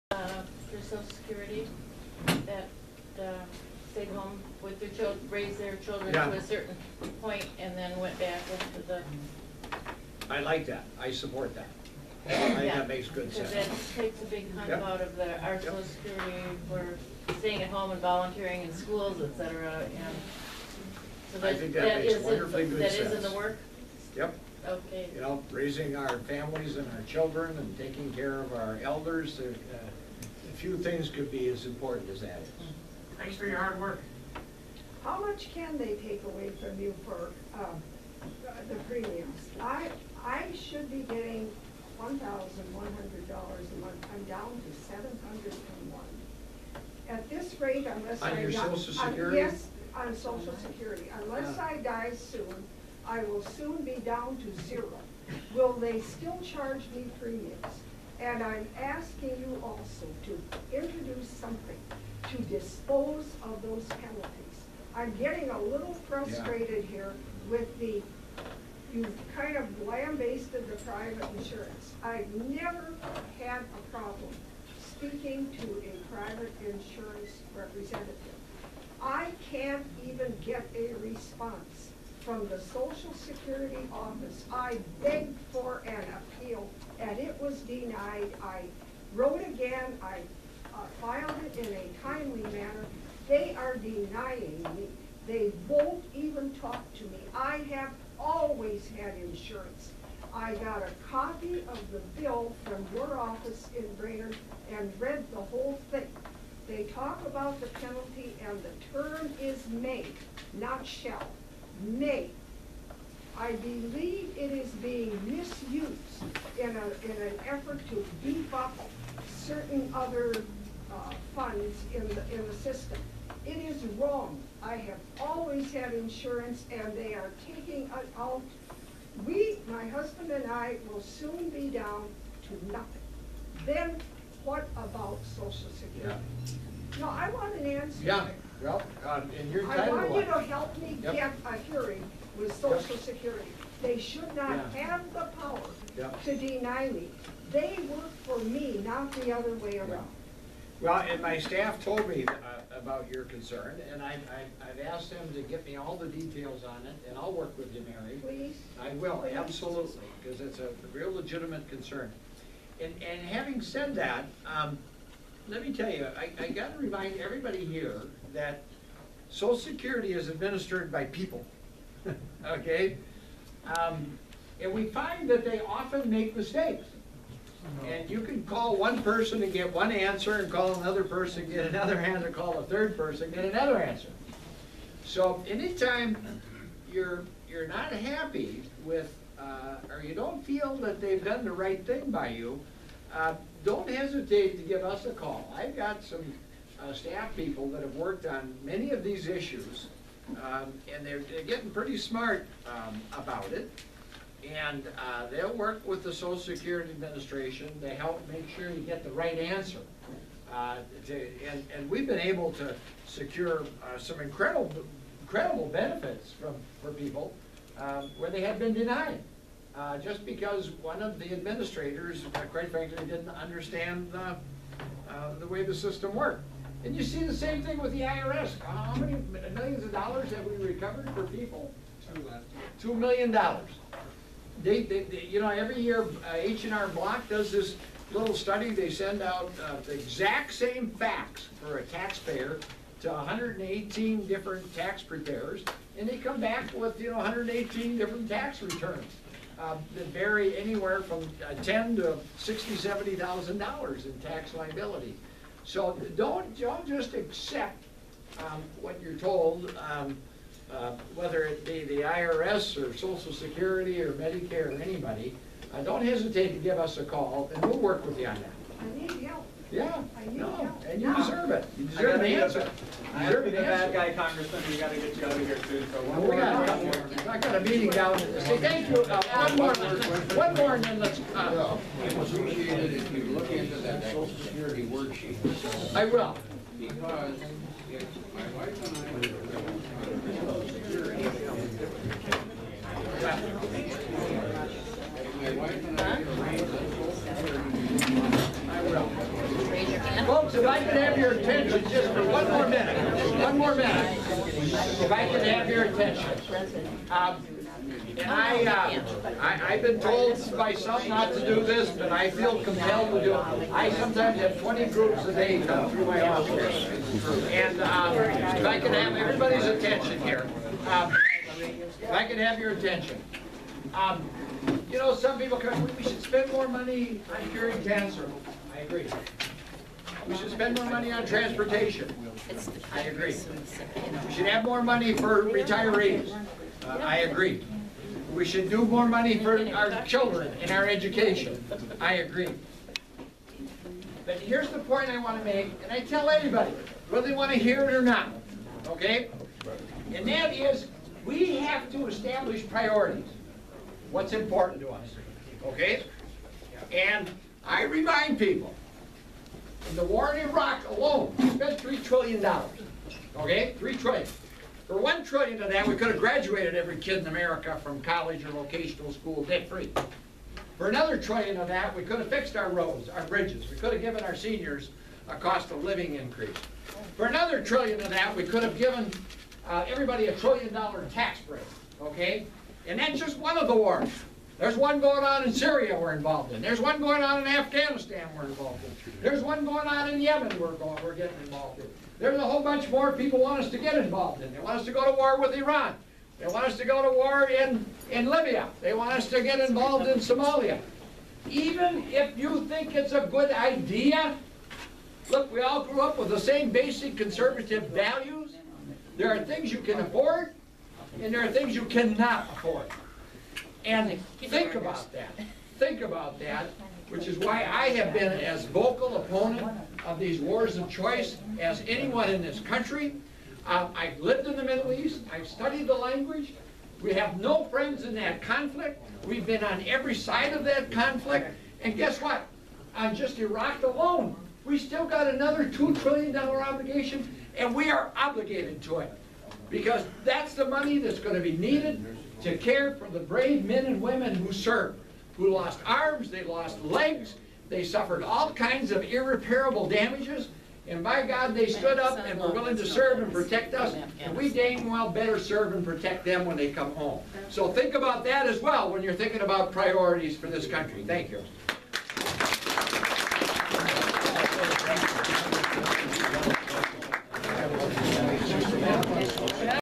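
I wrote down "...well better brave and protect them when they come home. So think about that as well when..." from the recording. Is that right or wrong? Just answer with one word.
wrong.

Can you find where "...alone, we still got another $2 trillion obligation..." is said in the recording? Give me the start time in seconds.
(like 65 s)
433 s.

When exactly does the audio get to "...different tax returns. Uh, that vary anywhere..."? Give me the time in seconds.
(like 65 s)
247 s.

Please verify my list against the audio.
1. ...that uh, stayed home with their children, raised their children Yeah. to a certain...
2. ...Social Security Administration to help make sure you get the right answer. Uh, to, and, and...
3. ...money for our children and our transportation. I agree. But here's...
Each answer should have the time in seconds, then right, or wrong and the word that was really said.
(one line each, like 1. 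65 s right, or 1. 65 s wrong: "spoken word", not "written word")
1. 2 s right
2. 206 s right
3. 339 s wrong: "education", not "transportation".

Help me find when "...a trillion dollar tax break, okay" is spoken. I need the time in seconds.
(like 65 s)
380 s.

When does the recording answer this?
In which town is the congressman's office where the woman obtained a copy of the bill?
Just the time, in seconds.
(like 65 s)
103 s.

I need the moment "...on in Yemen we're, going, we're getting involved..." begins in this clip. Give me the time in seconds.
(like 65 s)
389 s.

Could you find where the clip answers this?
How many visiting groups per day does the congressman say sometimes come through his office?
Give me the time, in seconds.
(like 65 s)
314 s.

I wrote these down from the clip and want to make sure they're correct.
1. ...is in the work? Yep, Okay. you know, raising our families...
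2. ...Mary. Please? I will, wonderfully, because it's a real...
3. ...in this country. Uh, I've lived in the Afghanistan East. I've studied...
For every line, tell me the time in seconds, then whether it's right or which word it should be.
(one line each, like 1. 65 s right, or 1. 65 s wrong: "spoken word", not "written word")
1. 22 s right
2. 157 s wrong: "absolutely", not "wonderfully"
3. 422 s wrong: "Middle", not "Afghanistan".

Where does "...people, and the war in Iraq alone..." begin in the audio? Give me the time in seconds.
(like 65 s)
358 s.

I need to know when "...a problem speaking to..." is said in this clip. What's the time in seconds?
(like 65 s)
73 s.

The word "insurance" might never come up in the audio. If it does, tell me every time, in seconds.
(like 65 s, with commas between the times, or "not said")
71 s, 76 s, 99 s, 125 s.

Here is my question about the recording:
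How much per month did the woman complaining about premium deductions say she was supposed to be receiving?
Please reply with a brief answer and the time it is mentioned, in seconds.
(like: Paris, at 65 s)
$1,100, at 42 s.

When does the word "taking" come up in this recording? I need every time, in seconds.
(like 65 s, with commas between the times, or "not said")
27 s, 127 s.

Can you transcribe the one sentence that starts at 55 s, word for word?
Will they still charge me premiums?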